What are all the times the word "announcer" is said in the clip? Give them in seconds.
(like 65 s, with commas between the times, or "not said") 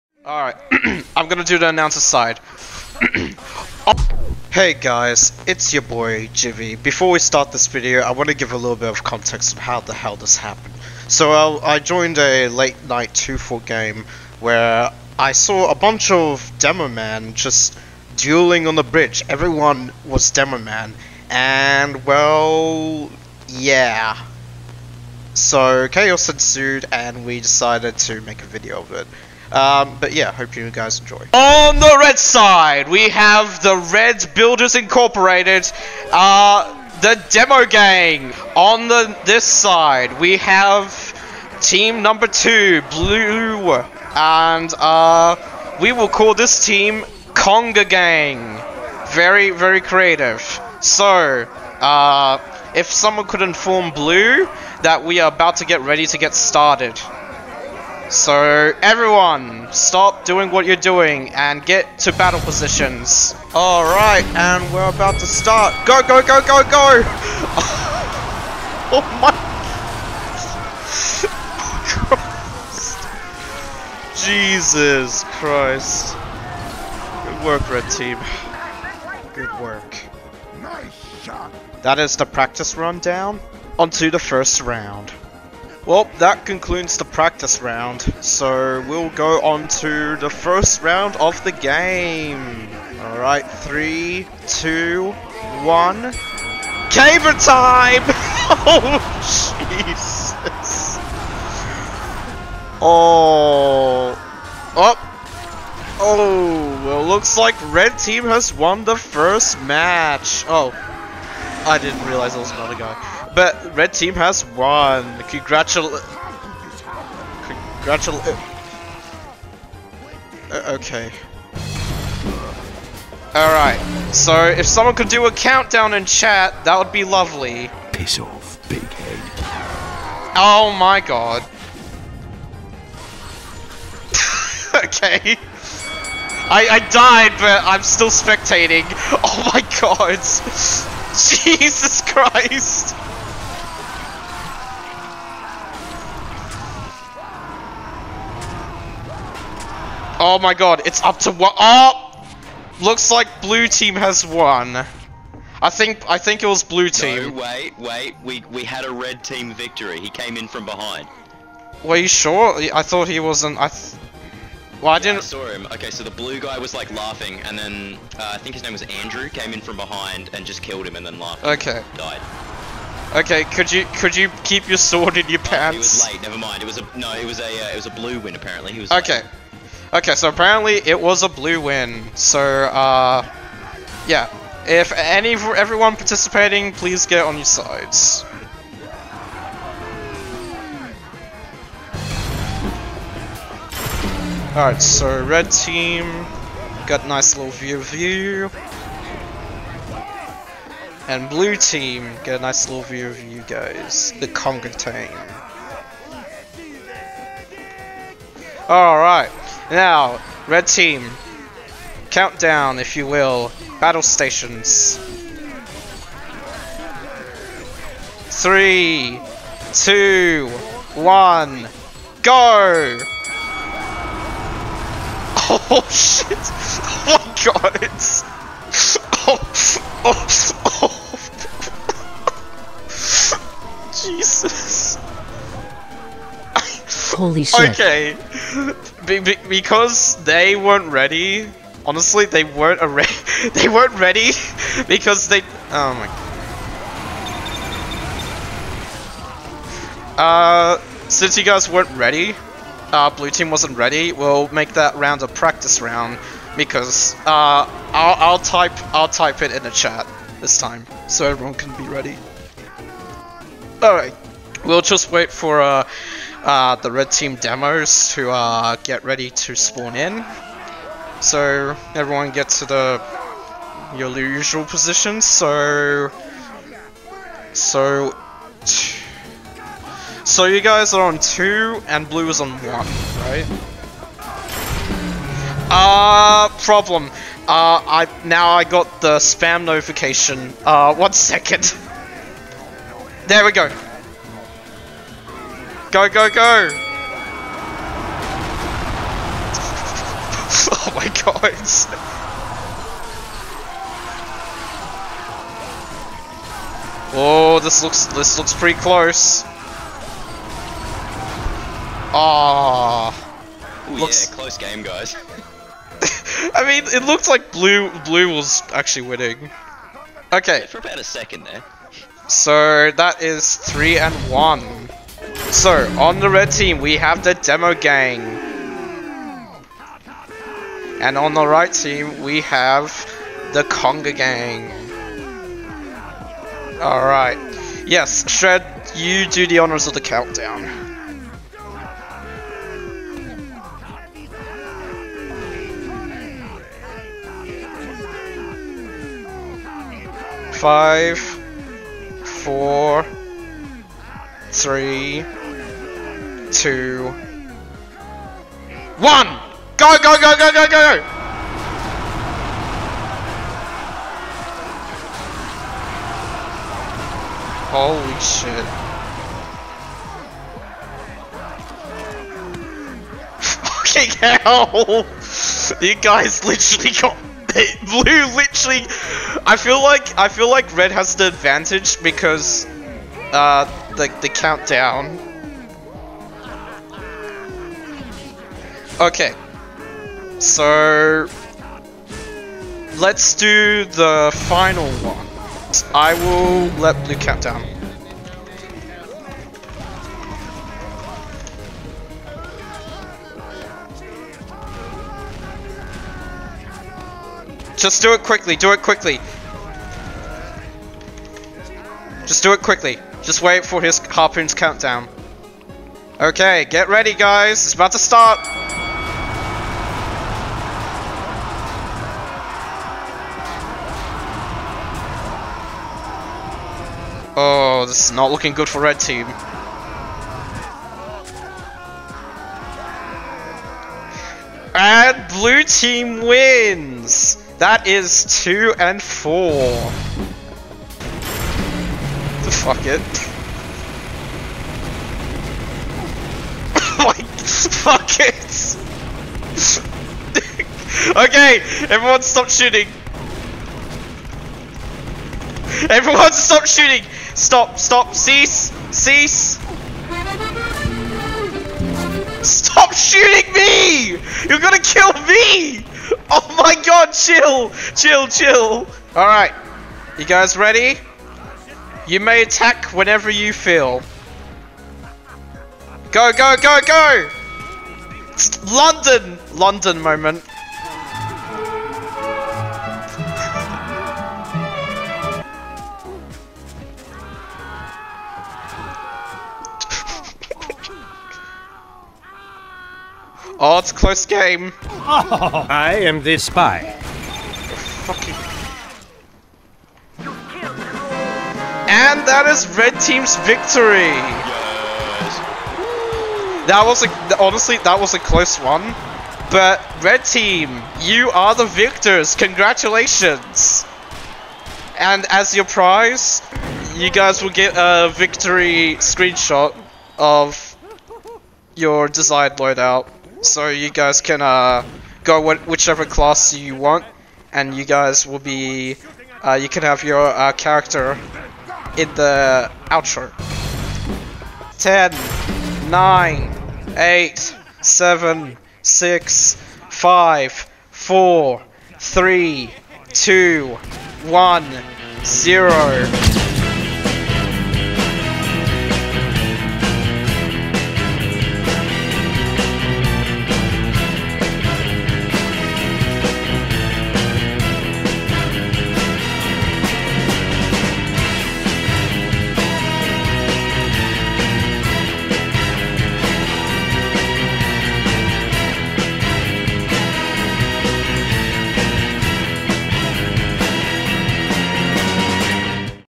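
1 s.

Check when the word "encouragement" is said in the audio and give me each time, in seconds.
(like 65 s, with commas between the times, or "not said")
not said.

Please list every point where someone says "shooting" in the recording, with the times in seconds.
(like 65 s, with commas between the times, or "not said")
452 s, 456 s, 462 s.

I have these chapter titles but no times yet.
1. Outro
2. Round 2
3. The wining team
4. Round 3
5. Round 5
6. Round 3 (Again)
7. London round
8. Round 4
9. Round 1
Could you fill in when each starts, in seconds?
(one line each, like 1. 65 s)
1. 546 s
2. 121 s
3. 500 s
4. 191 s
5. 394 s
6. 282 s
7. 439 s
8. 323 s
9. 61 s.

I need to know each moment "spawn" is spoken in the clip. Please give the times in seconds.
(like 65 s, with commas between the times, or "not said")
269 s.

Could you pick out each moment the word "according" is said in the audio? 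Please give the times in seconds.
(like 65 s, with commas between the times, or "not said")
not said.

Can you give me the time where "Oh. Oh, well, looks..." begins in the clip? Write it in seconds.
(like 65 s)
104 s.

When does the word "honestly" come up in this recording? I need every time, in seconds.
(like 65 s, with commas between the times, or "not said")
241 s, 507 s.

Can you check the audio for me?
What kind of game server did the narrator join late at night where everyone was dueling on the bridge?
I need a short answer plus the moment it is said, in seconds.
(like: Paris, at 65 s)
2-4, at 13 s.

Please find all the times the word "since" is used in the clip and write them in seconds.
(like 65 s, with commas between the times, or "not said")
251 s.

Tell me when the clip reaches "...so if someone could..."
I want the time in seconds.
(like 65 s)
124 s.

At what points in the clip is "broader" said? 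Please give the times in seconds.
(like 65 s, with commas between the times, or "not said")
not said.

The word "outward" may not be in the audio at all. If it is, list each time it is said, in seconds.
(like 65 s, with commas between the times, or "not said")
not said.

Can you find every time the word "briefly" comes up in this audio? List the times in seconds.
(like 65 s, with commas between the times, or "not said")
not said.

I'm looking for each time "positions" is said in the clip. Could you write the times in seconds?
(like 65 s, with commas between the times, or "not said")
62 s, 274 s.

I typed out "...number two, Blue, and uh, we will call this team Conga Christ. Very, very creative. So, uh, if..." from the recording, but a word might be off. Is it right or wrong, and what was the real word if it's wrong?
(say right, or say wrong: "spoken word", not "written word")
wrong: "Gang", not "Christ".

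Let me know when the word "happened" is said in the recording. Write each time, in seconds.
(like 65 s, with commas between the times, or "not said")
10 s.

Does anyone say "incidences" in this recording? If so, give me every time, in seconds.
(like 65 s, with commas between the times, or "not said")
not said.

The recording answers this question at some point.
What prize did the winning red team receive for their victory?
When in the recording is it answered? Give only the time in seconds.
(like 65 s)
518 s.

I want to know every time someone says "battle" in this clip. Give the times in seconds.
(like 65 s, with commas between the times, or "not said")
62 s, 213 s.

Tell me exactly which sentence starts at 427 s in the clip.
Oh, this is not looking good for red team.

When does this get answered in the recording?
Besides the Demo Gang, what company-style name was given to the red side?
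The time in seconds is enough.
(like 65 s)
33 s.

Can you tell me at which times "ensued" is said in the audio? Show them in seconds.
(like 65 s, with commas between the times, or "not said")
26 s.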